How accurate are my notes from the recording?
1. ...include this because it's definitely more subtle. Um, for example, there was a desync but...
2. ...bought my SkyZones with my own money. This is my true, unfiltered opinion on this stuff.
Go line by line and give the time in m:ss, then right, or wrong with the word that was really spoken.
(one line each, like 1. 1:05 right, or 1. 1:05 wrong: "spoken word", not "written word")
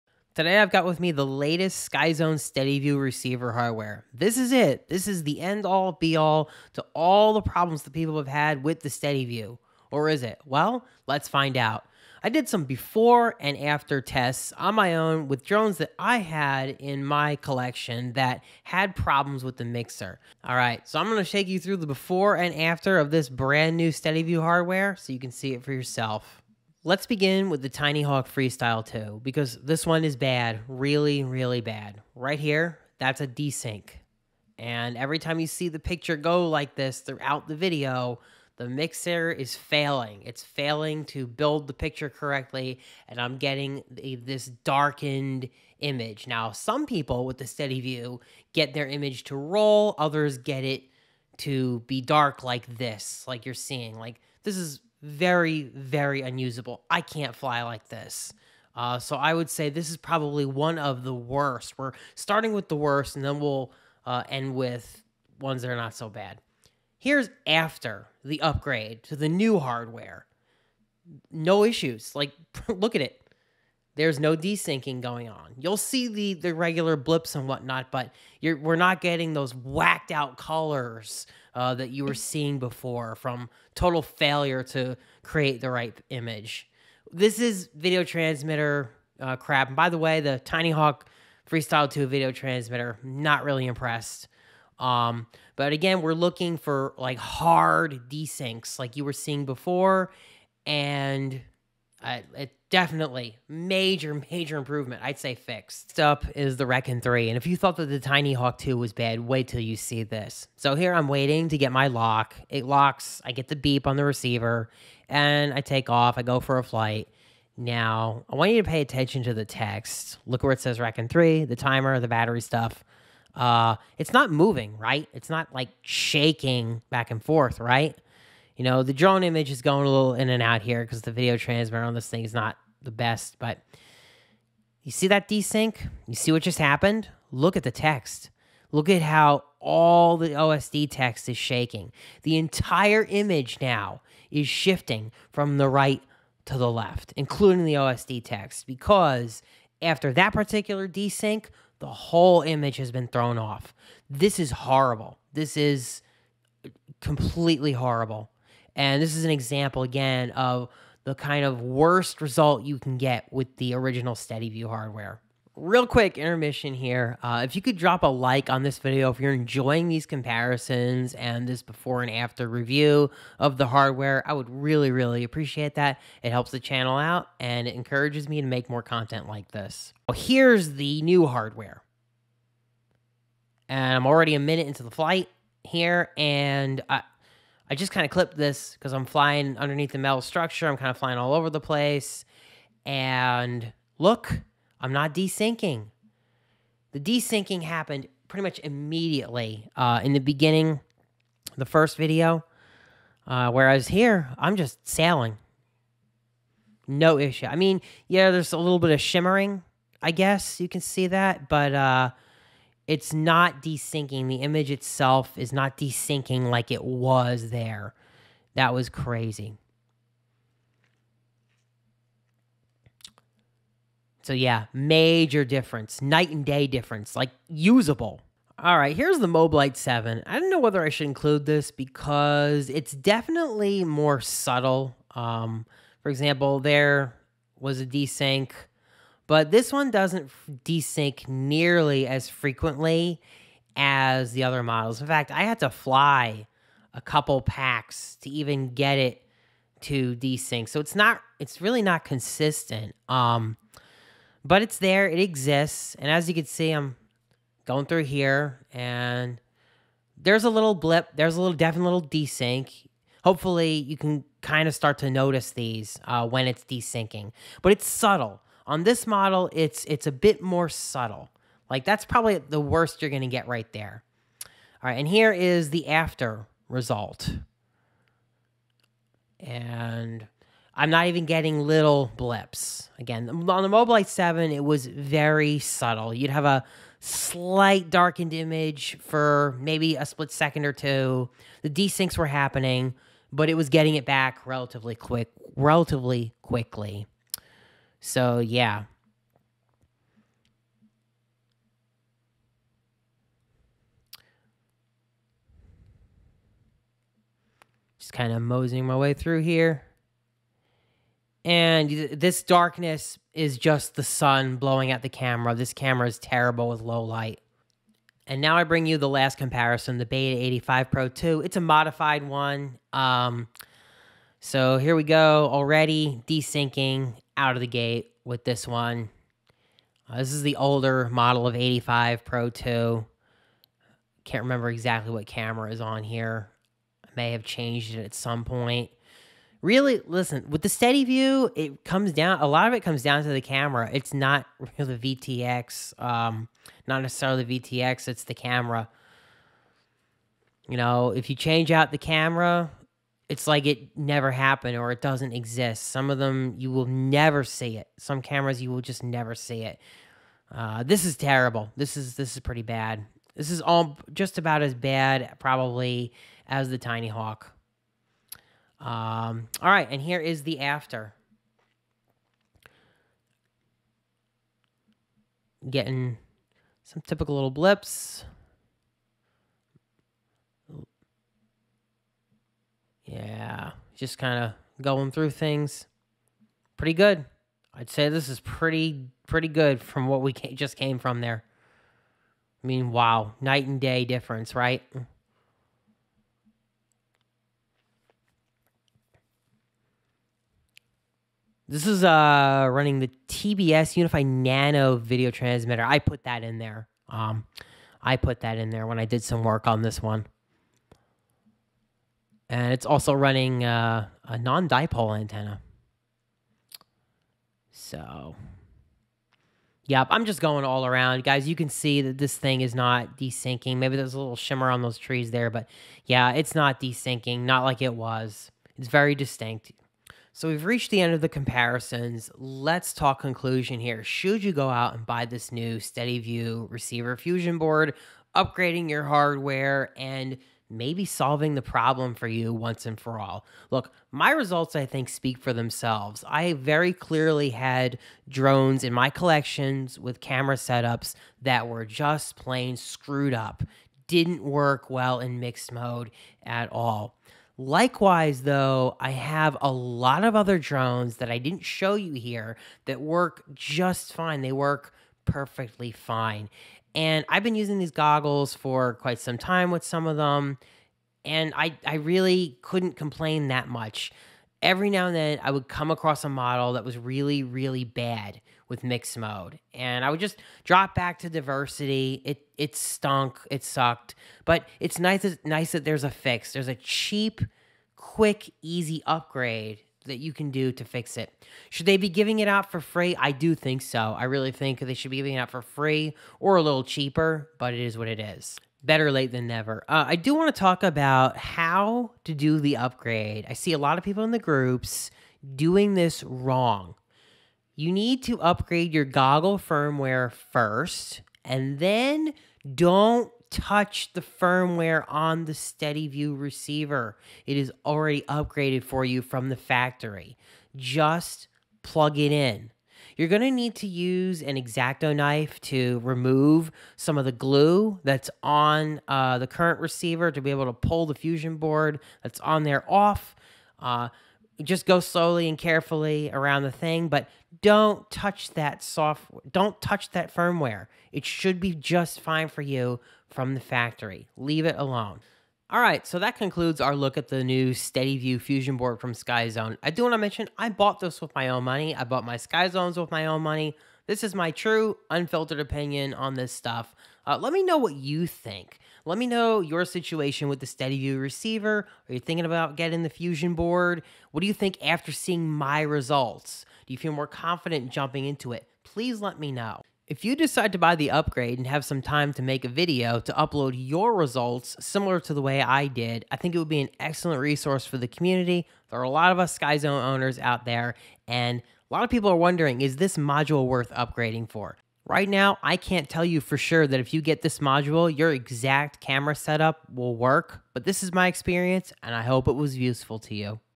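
1. 3:51 right
2. 9:12 right.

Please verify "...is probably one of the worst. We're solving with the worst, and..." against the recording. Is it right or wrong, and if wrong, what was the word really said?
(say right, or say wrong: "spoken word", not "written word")
wrong: "starting", not "solving".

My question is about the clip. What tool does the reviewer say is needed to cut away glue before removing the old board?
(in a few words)
X-Acto knife.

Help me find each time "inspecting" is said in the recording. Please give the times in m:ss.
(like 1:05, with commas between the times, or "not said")
not said.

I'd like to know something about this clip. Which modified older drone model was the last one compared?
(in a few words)
Beta 85 Pro 2.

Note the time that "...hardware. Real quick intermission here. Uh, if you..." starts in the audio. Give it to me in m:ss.
2:44.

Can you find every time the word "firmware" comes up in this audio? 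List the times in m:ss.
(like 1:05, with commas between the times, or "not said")
8:29, 8:34, 9:00.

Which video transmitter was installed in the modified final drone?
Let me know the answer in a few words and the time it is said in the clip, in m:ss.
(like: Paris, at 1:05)
TBS Unify Nano, at 6:43.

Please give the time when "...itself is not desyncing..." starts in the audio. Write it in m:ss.
3:34.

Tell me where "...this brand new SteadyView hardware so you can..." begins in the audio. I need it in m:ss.
0:23.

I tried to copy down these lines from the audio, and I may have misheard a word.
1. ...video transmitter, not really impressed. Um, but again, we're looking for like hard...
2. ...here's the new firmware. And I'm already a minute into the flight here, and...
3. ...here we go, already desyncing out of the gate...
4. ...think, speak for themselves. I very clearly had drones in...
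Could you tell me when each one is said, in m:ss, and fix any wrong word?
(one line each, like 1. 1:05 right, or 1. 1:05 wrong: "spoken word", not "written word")
1. 1:32 right
2. 3:00 wrong: "hardware", not "firmware"
3. 5:24 right
4. 7:24 right.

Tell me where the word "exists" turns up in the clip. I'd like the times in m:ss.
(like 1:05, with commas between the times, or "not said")
4:15, 5:55.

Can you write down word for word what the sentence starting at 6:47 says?
Um, I put that in there when I did some work on this one and it's also running uh, a non-dipole antenna.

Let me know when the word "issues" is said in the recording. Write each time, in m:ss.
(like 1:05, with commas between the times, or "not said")
1:11, 3:27.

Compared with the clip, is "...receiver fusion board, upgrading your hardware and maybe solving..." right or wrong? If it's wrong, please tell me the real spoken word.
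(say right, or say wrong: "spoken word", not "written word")
right.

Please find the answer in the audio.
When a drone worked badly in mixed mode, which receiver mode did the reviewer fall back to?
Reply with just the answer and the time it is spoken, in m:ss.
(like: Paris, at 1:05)
diversity, at 8:01.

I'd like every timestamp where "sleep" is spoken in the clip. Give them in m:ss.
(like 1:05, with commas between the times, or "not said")
not said.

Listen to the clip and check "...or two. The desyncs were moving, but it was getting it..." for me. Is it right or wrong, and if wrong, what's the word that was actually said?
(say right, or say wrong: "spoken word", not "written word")
wrong: "happening", not "moving".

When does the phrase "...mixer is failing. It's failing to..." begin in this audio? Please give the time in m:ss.
0:38.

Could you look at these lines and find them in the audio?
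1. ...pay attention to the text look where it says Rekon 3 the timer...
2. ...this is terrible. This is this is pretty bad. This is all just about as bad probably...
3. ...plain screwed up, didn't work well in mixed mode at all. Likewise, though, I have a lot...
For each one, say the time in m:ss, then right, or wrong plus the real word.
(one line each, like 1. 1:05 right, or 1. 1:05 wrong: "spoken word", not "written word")
1. 1:58 right
2. 6:00 right
3. 7:32 right.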